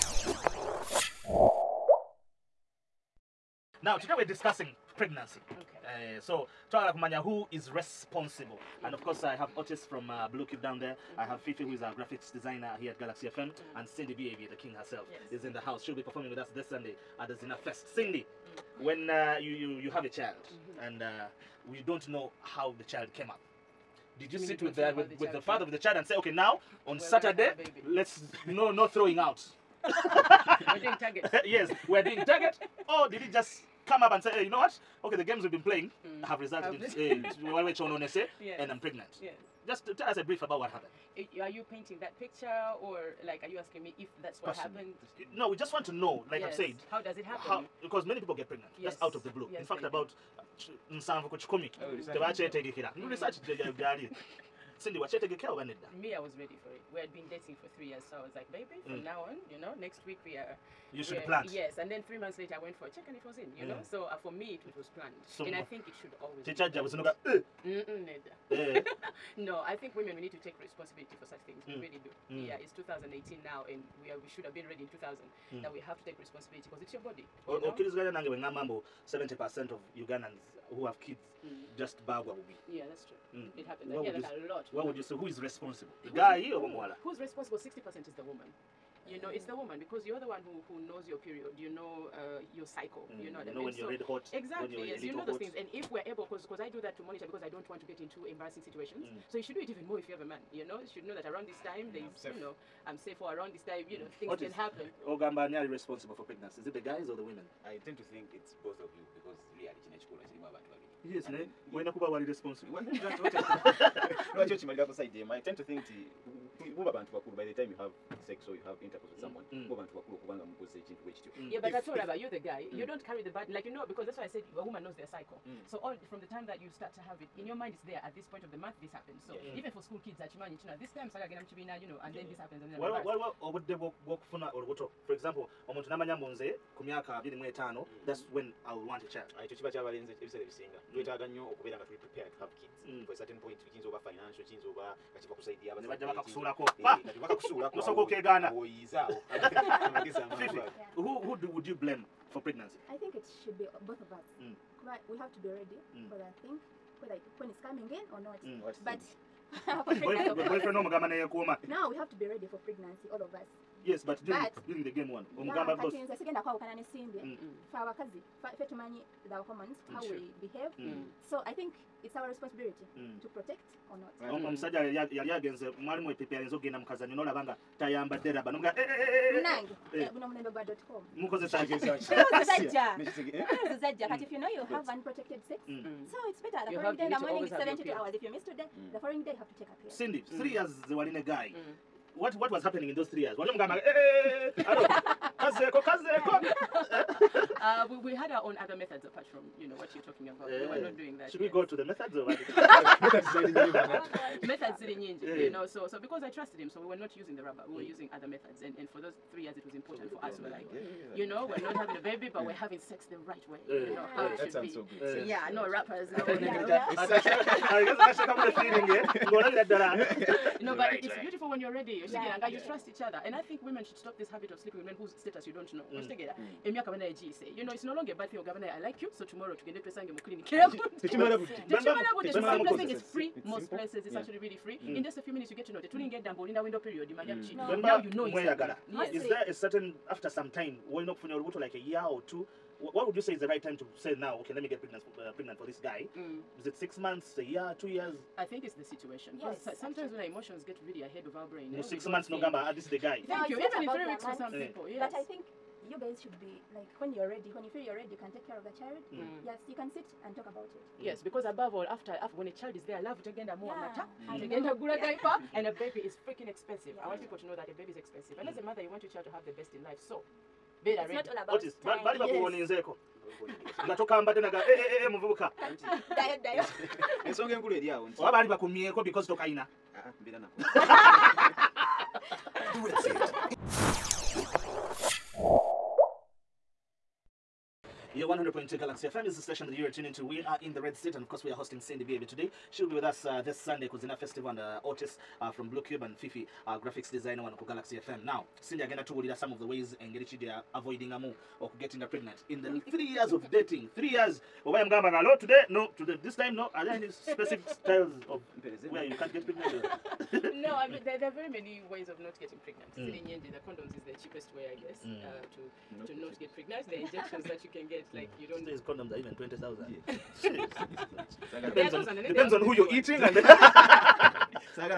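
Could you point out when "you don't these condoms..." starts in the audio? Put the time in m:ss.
5:18.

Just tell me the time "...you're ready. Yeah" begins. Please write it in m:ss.
3:41.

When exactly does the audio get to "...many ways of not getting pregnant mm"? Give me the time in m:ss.
5:11.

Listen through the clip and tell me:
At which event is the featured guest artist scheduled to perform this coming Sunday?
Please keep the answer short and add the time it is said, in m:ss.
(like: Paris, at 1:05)
Zina Fest, at 0:17.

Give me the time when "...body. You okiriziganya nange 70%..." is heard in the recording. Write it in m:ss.
1:17.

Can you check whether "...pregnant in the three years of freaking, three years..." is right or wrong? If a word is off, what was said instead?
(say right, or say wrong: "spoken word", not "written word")
wrong: "dating", not "freaking".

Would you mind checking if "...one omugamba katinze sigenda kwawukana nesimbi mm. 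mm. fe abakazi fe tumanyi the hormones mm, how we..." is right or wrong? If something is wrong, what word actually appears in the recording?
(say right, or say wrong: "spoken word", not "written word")
right.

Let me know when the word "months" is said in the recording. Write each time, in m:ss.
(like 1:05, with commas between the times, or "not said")
1:02, 2:08, 4:06, 4:12.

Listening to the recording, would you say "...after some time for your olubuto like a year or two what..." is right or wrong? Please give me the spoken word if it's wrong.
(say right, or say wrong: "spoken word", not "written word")
right.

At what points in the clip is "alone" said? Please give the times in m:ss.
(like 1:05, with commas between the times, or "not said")
not said.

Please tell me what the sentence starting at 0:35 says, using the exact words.
Okay, the games we've been playing mm.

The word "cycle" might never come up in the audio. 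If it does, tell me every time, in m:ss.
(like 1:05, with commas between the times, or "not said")
1:32, 2:05.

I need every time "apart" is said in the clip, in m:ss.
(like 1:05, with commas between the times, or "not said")
3:19.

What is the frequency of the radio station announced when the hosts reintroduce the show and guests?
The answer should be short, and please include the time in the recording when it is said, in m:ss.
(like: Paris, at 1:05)
100.2, at 4:48.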